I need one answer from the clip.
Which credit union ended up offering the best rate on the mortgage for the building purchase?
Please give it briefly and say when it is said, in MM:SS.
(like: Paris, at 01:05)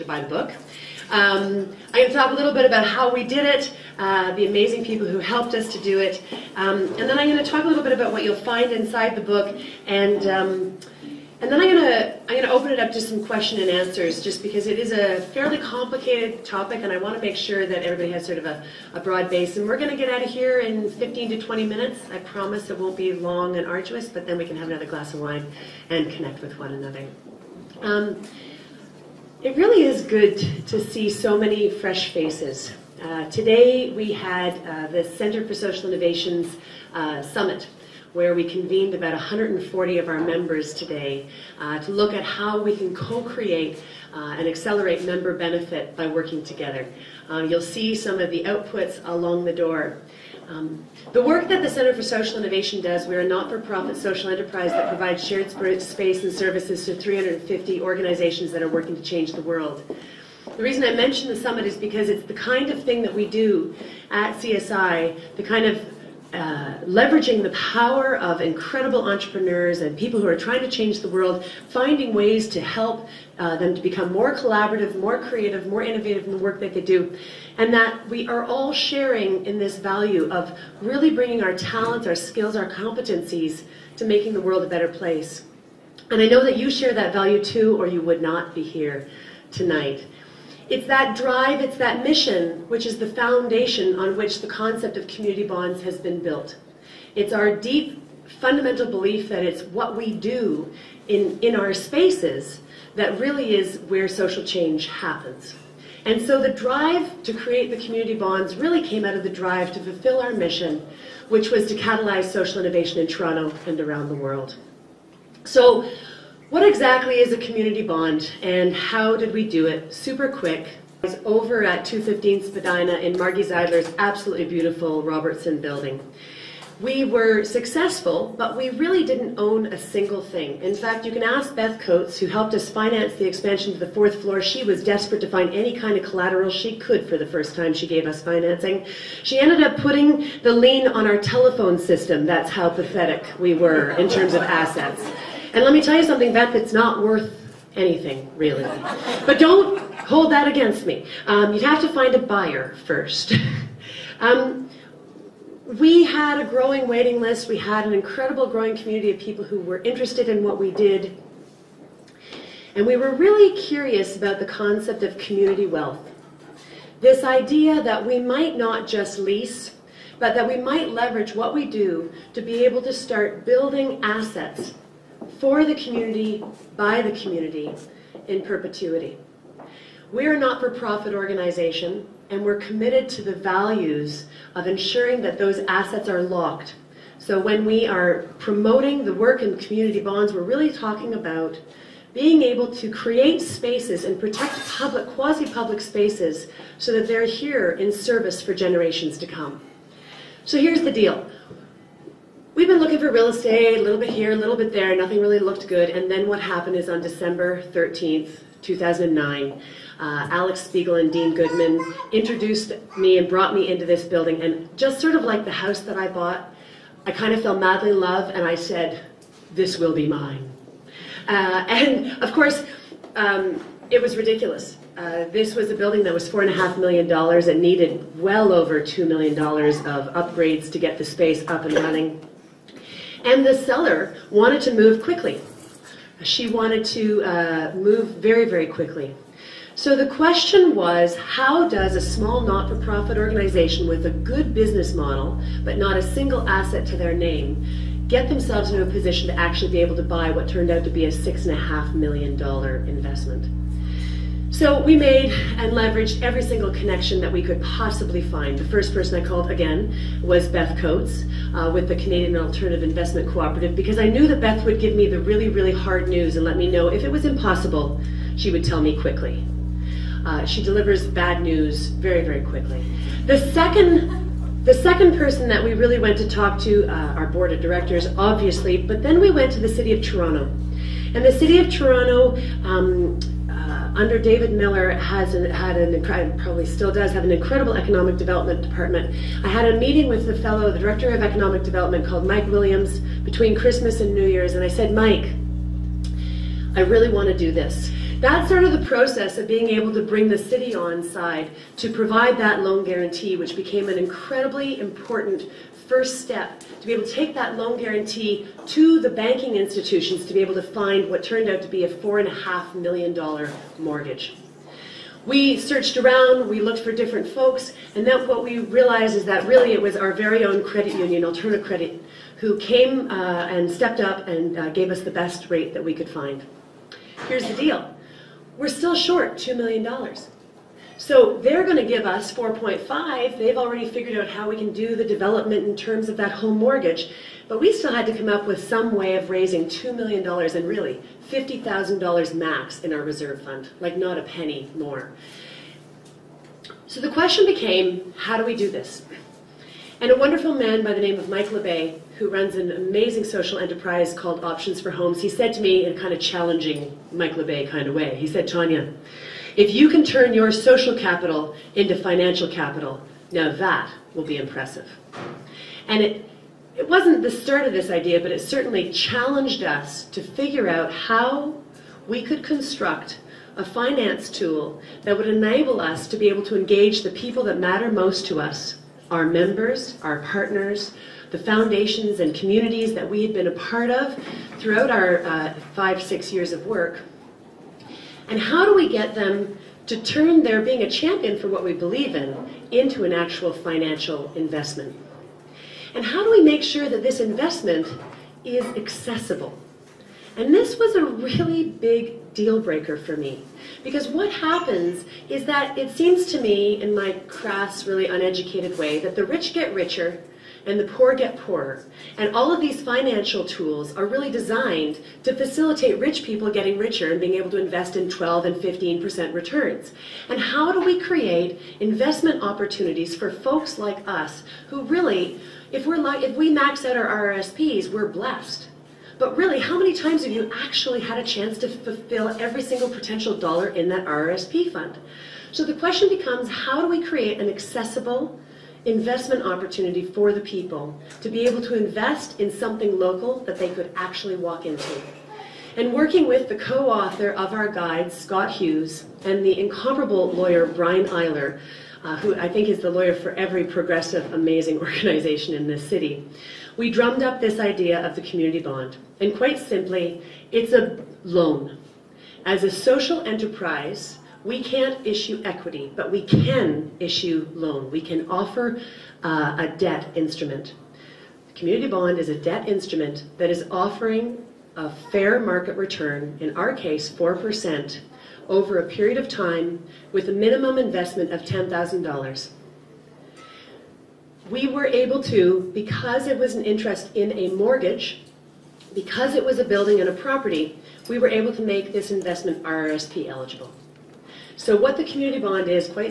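Alternative Credit, at 05:21.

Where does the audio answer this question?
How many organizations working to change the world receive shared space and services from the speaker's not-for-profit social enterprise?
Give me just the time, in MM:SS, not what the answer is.
00:56.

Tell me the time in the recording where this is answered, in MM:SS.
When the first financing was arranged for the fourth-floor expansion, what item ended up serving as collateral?
02:21.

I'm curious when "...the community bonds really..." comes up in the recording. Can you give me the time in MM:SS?
01:47.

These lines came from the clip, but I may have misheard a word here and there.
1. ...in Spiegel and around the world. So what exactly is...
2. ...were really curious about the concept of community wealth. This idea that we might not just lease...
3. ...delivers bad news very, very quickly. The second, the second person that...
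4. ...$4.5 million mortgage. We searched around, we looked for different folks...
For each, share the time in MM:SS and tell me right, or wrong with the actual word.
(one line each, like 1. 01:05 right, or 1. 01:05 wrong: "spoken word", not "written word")
1. 01:52 wrong: "Toronto", not "Spiegel"
2. 02:42 right
3. 04:30 right
4. 05:11 right.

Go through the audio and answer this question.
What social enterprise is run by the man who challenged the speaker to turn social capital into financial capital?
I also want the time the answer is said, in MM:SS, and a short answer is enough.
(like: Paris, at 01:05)
Options for Homes, at 05:54.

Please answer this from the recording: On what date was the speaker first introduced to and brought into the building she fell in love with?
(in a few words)
December 13, 2009.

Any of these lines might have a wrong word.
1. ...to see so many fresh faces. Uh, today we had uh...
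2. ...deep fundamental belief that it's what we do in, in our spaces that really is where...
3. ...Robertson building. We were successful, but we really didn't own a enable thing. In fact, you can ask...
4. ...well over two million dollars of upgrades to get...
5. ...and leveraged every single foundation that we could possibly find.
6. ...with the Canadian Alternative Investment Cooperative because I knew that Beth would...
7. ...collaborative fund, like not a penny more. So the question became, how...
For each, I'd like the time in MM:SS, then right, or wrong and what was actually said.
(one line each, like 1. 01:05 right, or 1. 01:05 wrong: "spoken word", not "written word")
1. 00:30 right
2. 01:37 right
3. 02:05 wrong: "single", not "enable"
4. 03:48 right
5. 04:15 wrong: "connection", not "foundation"
6. 04:21 right
7. 05:43 wrong: "reserve", not "collaborative".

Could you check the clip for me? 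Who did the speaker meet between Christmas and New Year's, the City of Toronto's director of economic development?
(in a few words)
Mike Williams.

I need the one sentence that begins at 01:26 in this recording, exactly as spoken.
And I know that you share that value too, or you would not be here tonight.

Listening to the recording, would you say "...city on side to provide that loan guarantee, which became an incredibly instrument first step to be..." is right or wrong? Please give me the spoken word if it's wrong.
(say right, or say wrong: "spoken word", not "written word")
wrong: "important", not "instrument".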